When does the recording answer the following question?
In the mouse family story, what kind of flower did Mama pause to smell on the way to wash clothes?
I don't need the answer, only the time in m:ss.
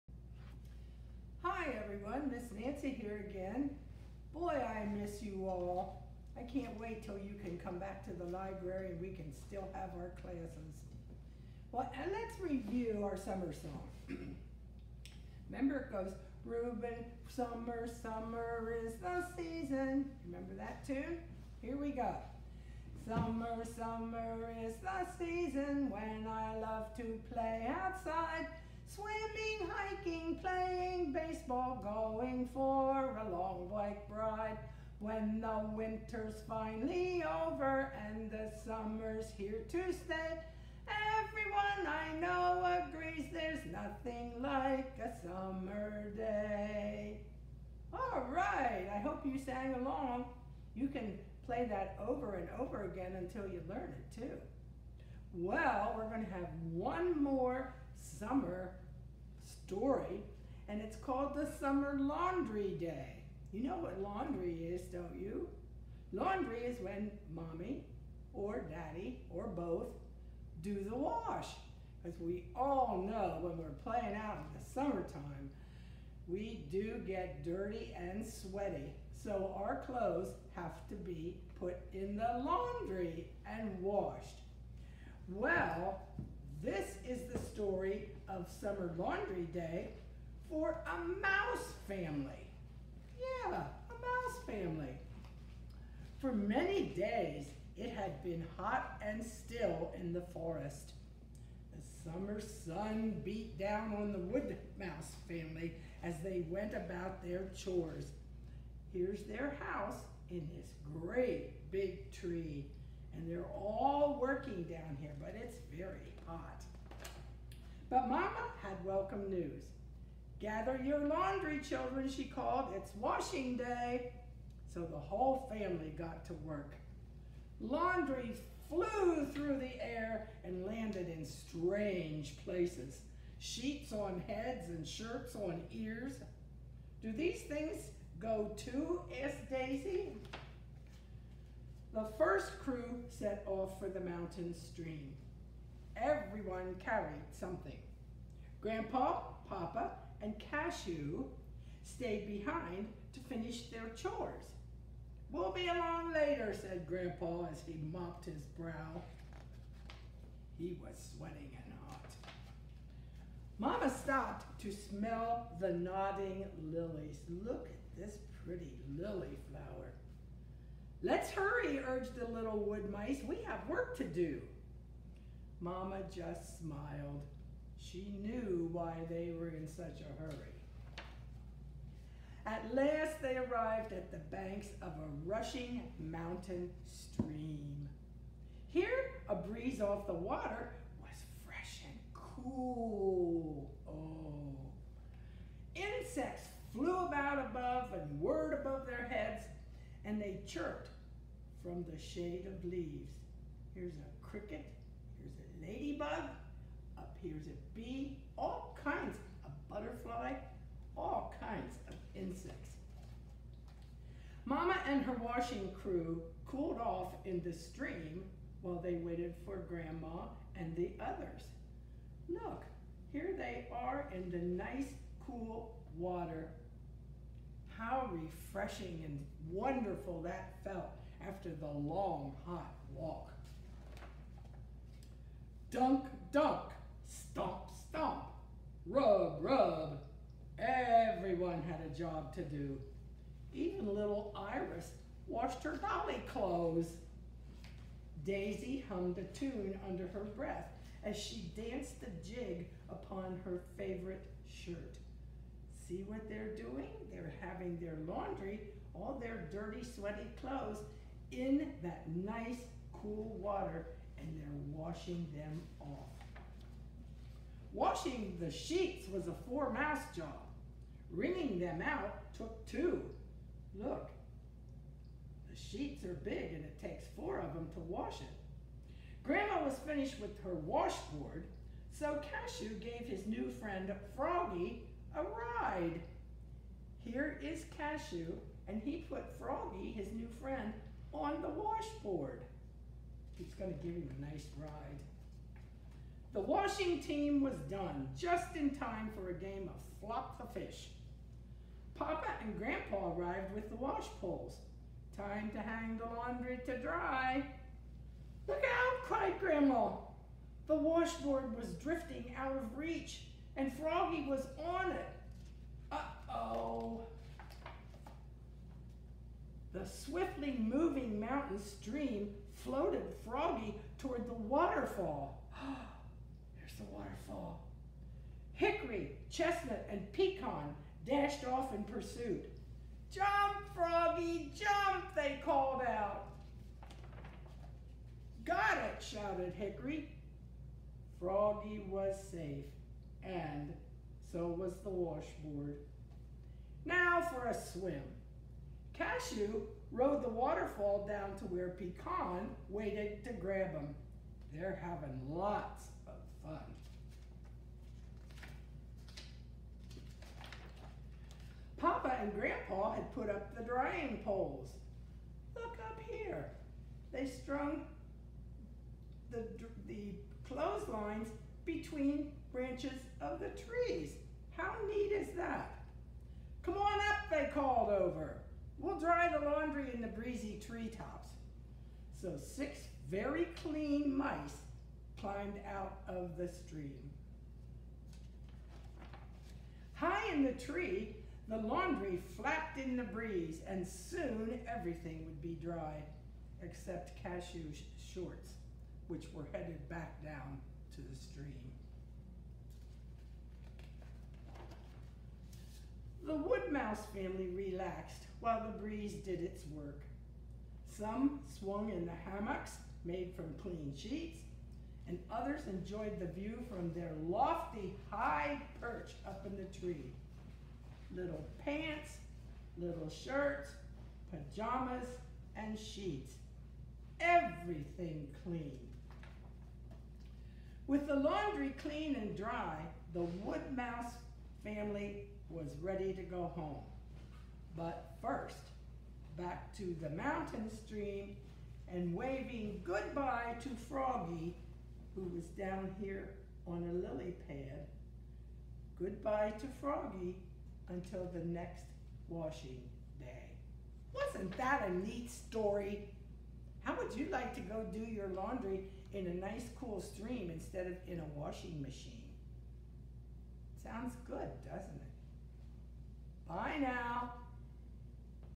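2:45.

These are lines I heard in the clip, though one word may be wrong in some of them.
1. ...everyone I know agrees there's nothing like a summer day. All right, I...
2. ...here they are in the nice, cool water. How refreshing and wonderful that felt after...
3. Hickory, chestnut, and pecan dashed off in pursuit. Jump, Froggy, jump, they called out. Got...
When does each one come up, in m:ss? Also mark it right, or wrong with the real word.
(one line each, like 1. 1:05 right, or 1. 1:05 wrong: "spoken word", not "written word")
1. 0:41 right
2. 3:43 right
3. 5:28 right.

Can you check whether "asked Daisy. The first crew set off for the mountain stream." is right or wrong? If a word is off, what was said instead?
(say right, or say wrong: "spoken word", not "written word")
right.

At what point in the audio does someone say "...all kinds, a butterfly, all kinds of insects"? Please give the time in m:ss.
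3:28.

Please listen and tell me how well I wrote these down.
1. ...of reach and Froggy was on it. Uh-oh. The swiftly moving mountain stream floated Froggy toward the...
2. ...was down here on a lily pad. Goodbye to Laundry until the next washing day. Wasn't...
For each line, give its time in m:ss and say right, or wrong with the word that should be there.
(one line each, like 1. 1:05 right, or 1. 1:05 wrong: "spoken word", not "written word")
1. 5:12 right
2. 7:25 wrong: "Froggy", not "Laundry".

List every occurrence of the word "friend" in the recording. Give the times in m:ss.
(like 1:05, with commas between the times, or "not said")
4:43, 4:50.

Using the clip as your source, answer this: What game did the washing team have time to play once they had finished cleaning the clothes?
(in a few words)
Flop the fish.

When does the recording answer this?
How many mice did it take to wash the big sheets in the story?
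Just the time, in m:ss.
4:29.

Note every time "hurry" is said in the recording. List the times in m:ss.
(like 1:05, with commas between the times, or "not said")
2:51, 3:00.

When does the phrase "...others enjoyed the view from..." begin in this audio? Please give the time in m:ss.
6:55.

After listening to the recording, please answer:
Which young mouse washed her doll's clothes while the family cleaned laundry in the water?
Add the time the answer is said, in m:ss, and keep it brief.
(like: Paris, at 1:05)
Iris, at 4:04.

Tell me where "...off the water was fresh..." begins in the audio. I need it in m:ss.
3:09.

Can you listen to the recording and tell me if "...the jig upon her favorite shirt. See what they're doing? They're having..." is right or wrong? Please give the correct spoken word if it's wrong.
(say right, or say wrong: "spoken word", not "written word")
right.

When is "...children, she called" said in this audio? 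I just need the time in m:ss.
2:01.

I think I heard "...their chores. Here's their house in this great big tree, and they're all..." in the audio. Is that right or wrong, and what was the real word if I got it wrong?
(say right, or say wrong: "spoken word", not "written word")
right.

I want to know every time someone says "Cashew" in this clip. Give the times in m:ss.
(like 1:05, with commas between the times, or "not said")
2:30, 4:42, 4:47, 5:48, 6:37.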